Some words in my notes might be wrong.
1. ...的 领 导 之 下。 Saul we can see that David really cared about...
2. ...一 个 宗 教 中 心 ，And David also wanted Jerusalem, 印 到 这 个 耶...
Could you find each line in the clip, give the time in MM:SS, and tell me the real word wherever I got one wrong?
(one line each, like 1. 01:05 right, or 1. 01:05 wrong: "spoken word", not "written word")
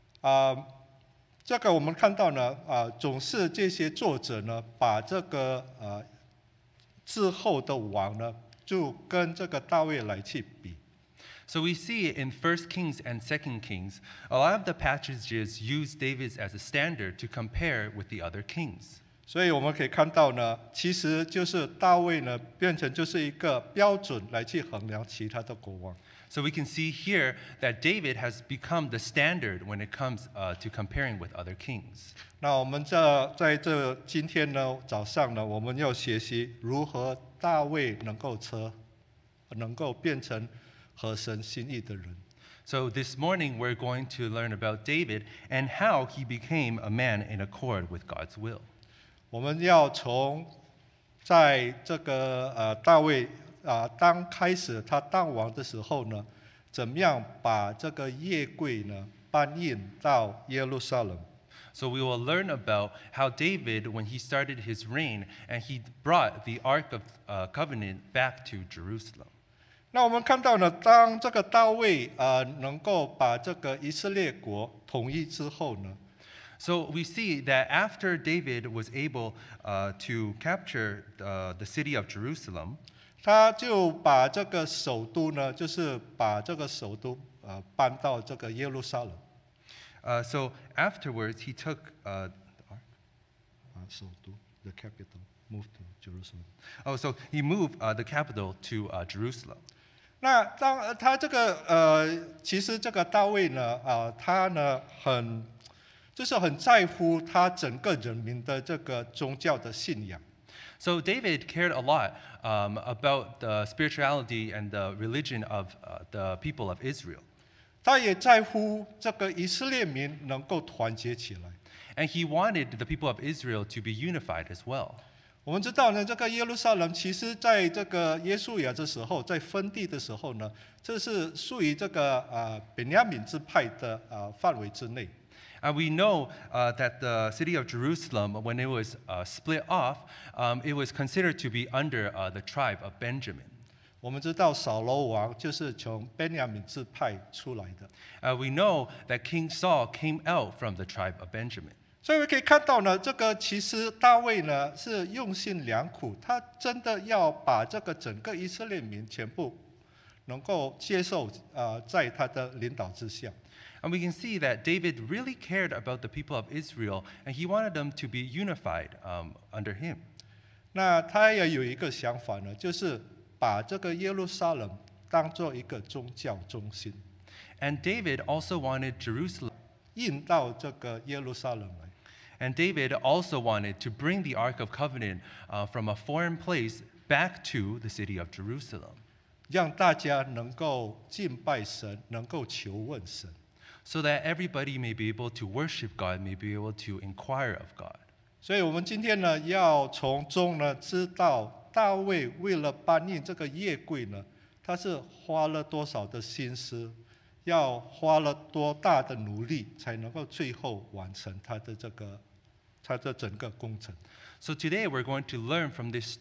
1. 02:42 wrong: "And", not "Saul"
2. 02:55 right.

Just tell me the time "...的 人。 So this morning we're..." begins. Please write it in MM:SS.
00:41.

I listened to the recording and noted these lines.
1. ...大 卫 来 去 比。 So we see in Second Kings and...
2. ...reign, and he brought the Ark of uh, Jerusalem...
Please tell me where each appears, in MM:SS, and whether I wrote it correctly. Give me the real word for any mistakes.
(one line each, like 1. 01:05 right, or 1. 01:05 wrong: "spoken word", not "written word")
1. 00:09 wrong: "First", not "Second"
2. 01:04 wrong: "Covenant", not "Jerusalem".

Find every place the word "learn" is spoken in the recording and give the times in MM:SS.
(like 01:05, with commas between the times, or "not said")
00:44, 01:02, 03:35.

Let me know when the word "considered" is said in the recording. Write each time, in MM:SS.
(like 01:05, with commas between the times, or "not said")
02:20.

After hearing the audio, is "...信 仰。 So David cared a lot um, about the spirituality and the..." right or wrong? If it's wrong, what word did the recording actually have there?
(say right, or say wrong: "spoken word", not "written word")
right.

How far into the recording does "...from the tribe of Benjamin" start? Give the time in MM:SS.
02:30.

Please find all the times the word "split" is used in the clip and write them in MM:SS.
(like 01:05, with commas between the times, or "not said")
02:19.